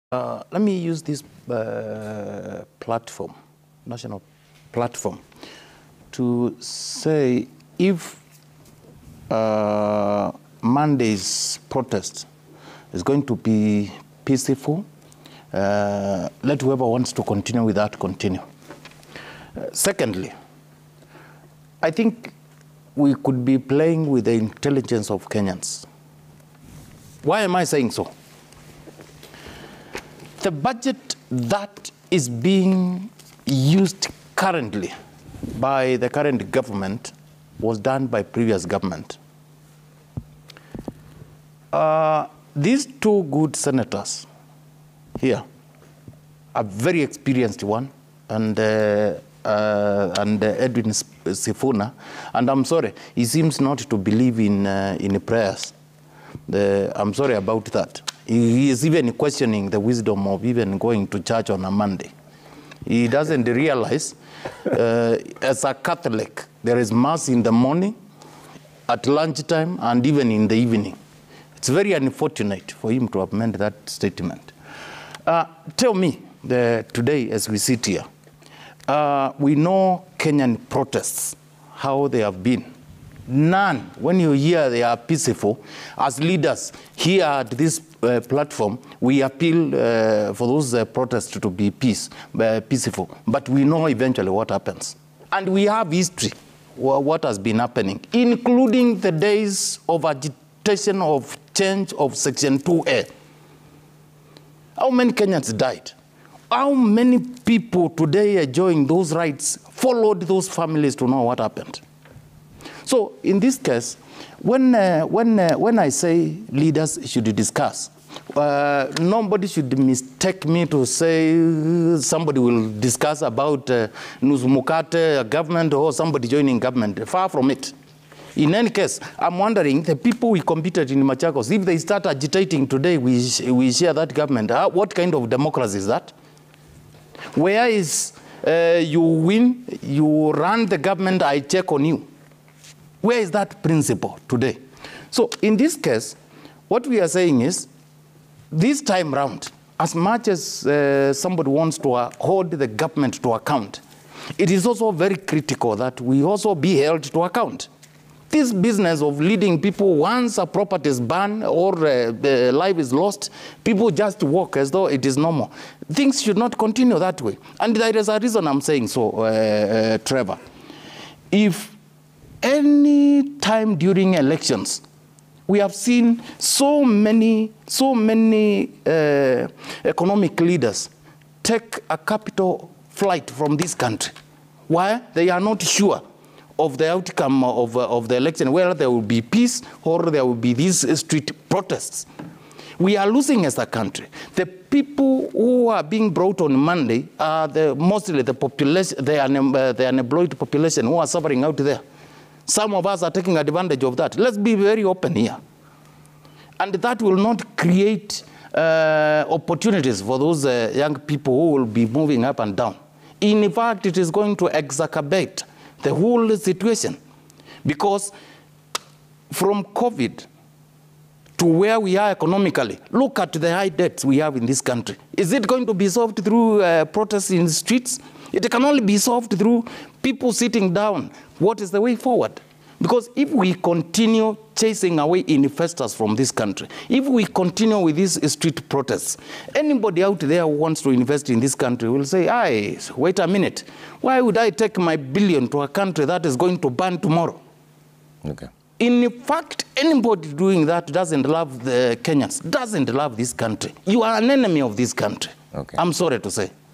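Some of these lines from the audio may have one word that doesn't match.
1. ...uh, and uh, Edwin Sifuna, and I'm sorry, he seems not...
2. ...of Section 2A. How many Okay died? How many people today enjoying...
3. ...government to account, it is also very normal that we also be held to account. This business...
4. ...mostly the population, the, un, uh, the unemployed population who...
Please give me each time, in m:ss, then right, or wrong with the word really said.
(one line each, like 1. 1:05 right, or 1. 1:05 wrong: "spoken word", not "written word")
1. 0:49 right
2. 1:41 wrong: "Kenyans", not "Okay"
3. 2:32 wrong: "critical", not "normal"
4. 3:17 right.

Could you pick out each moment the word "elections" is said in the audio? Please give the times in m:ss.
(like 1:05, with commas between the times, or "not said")
2:54, 3:08.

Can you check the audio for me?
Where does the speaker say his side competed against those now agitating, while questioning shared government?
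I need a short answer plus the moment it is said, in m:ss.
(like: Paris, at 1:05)
Machakos, at 2:11.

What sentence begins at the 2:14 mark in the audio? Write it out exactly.
Uh, what kind of democracy is that?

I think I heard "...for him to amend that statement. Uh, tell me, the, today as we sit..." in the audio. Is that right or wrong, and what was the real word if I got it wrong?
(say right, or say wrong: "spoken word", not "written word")
right.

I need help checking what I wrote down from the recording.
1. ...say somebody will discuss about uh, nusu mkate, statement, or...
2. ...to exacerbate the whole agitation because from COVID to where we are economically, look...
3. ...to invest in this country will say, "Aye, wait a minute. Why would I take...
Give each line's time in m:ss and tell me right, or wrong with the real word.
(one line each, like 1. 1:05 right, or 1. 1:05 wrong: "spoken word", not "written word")
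1. 2:00 wrong: "government", not "statement"
2. 3:34 wrong: "situation", not "agitation"
3. 4:00 right.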